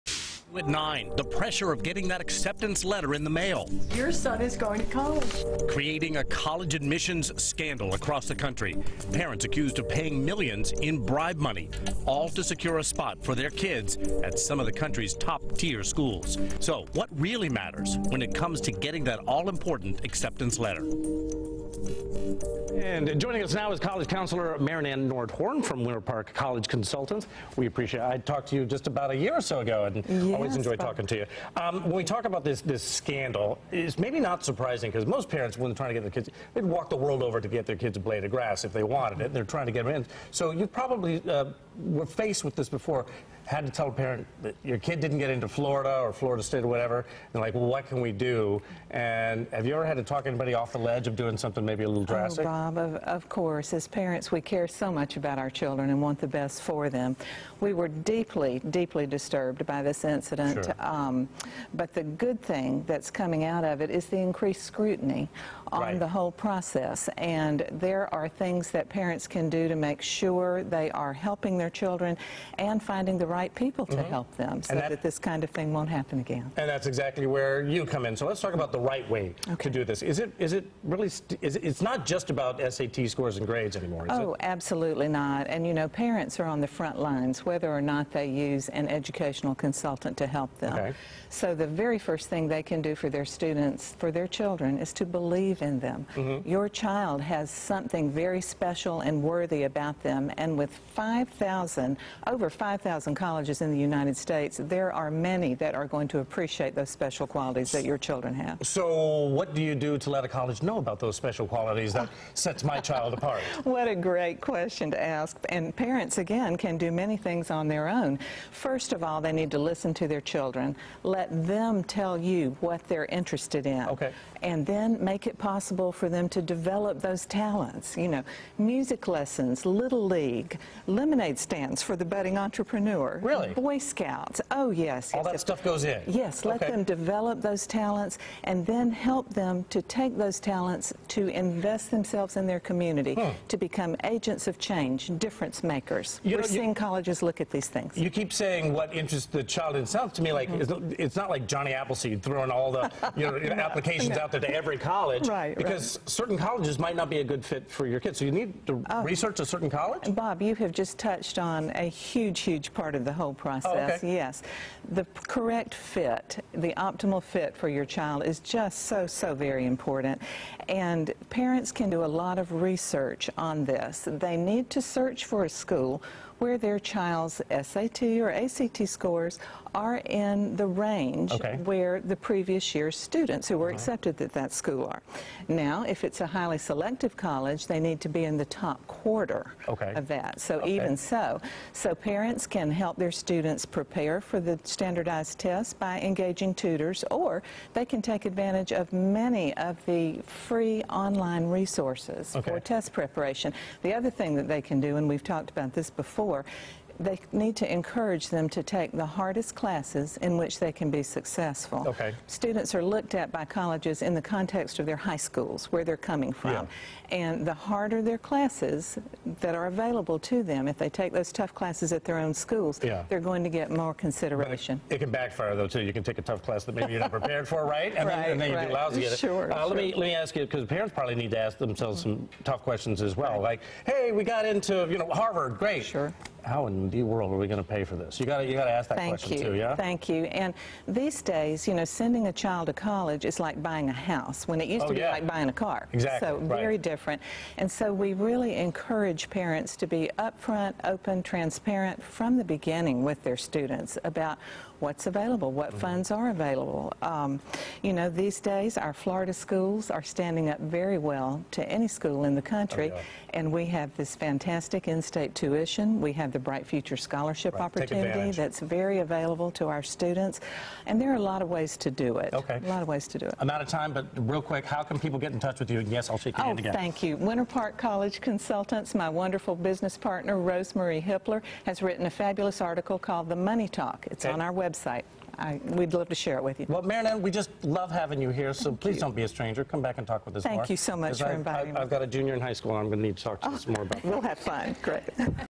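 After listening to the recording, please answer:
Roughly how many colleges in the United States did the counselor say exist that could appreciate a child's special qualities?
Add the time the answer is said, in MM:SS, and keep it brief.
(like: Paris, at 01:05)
over 5,000, at 01:42.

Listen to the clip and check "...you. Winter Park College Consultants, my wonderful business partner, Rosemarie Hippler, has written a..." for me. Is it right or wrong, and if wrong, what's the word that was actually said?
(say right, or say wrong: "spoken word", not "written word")
right.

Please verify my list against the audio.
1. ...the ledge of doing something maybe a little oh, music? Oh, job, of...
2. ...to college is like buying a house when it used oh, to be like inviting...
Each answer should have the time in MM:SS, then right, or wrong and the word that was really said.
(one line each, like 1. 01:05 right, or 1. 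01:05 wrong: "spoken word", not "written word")
1. 00:50 wrong: "drastic", not "music"
2. 04:02 wrong: "buying", not "inviting".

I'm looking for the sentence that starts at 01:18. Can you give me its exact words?
So let's talk about the right way okay.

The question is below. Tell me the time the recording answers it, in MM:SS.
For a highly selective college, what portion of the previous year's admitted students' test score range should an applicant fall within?
03:08.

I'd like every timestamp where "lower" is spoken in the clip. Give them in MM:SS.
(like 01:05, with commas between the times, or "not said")
03:26.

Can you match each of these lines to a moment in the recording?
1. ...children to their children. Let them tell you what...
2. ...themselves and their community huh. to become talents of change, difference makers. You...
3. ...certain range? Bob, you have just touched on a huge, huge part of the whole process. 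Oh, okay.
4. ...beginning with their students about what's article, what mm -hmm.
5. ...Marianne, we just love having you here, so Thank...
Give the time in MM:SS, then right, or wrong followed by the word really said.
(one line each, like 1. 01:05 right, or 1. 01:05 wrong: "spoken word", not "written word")
1. 01:59 wrong: "listen", not "children"
2. 02:22 wrong: "agents", not "talents"
3. 02:39 wrong: "college", not "range"
4. 04:12 wrong: "available", not "article"
5. 04:46 right.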